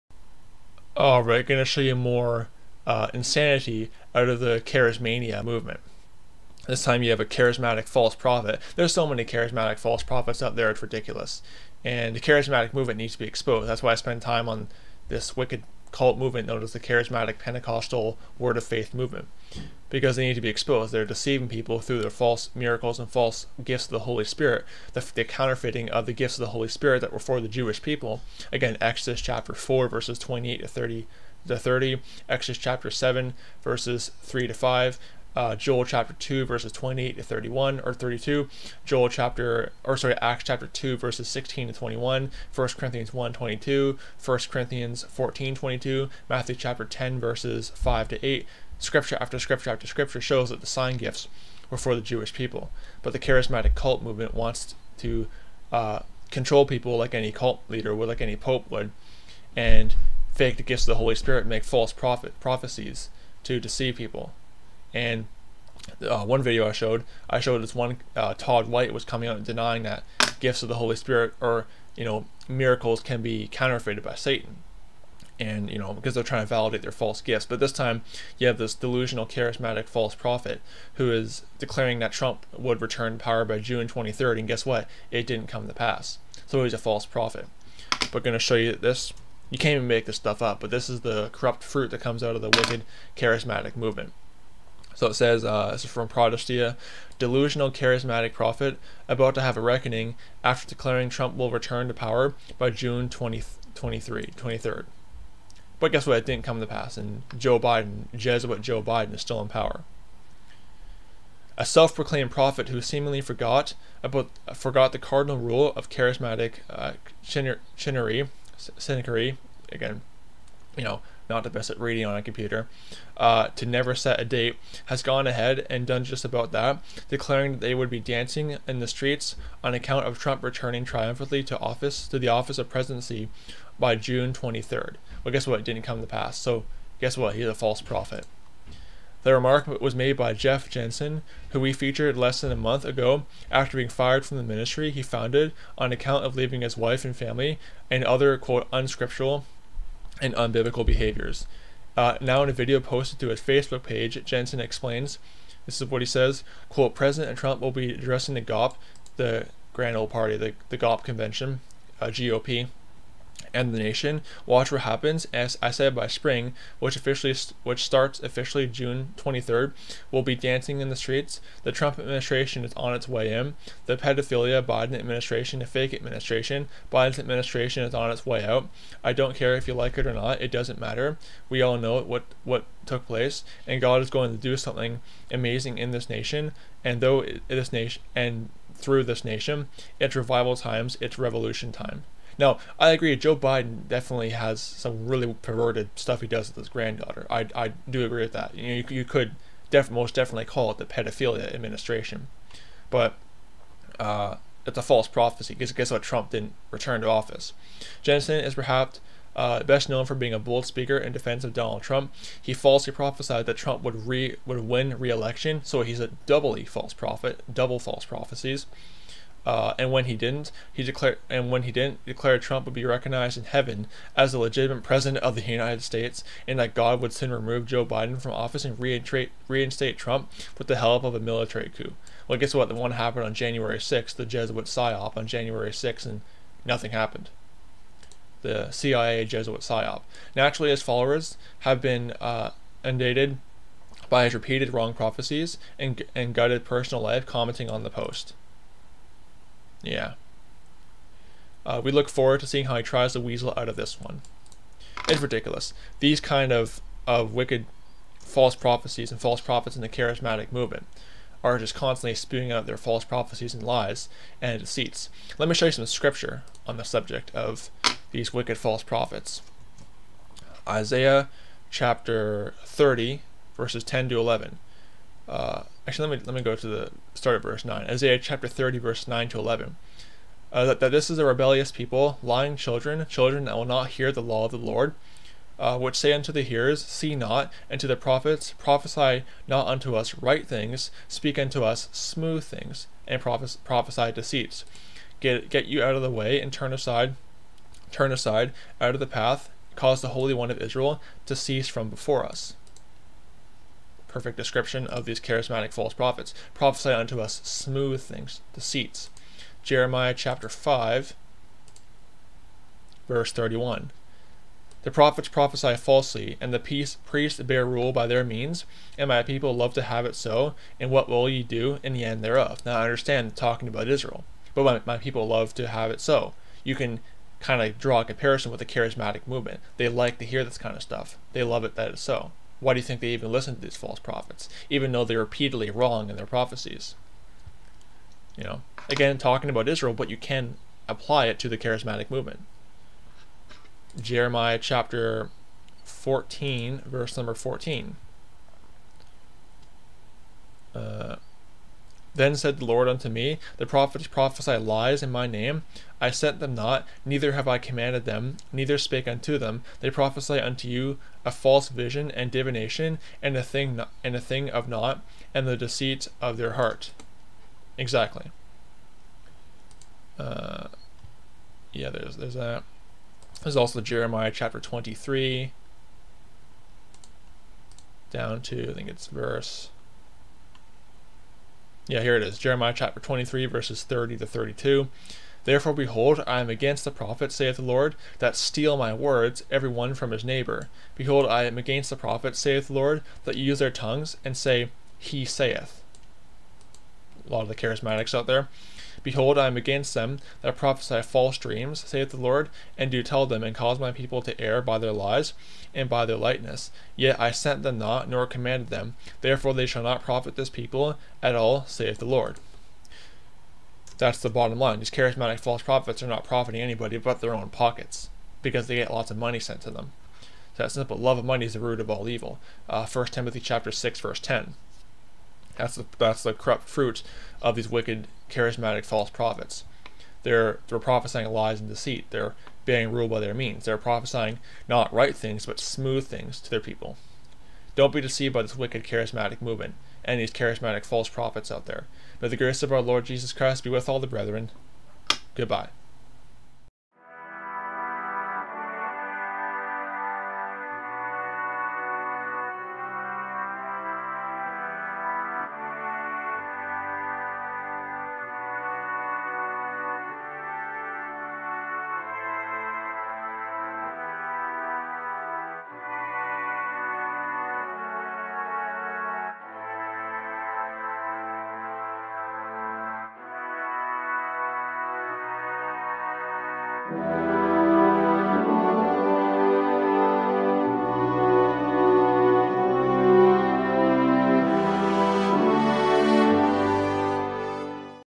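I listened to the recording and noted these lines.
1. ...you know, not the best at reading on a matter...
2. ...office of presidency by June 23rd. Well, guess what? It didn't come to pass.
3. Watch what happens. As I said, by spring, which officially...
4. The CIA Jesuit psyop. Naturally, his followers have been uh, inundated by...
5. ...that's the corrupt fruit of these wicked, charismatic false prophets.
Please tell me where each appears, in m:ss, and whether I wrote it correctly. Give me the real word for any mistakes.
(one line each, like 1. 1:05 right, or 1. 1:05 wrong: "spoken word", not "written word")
1. 2:00 wrong: "computer", not "matter"
2. 2:12 right
3. 2:44 right
4. 3:58 right
5. 7:05 right.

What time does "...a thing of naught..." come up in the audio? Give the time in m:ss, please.
6:04.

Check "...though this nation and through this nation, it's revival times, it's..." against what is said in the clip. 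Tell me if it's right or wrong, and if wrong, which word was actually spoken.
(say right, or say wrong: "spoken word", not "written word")
right.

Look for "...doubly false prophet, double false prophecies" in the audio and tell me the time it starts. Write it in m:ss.
3:36.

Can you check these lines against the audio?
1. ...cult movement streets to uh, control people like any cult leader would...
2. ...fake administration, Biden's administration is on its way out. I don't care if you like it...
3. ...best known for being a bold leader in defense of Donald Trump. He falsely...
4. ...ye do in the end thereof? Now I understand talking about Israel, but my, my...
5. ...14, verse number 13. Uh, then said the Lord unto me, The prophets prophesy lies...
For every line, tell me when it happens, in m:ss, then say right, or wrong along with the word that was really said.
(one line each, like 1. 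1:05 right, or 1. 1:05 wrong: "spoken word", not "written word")
1. 0:53 wrong: "wants", not "streets"
2. 2:55 right
3. 3:29 wrong: "speaker", not "leader"
4. 5:21 right
5. 5:45 wrong: "14", not "13".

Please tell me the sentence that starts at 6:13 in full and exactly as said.
There's also Jeremiah chapter 23, down to I think it's verse yeah, here it is Jeremiah chapter 23, verses 30 to 32.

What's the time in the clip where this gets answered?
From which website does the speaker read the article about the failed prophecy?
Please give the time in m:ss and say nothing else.
1:36.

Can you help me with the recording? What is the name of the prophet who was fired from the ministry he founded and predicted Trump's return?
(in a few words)
Jeff Jansen.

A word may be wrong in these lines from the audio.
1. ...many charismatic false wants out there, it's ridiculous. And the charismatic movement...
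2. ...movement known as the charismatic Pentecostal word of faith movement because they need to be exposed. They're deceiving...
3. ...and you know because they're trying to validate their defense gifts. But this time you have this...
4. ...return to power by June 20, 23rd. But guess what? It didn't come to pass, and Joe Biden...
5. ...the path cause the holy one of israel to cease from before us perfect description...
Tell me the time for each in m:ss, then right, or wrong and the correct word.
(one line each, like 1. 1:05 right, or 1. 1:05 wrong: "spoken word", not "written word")
1. 0:09 wrong: "prophets", not "wants"
2. 0:16 right
3. 1:15 wrong: "false", not "defense"
4. 1:41 right
5. 4:58 right.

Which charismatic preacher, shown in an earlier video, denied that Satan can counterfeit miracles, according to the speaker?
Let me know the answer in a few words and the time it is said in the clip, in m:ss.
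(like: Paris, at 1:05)
Todd White, at 1:08.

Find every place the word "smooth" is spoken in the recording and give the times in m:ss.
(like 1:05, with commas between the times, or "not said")
4:51, 5:07, 7:15.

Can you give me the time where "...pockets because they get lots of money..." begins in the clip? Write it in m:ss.
6:57.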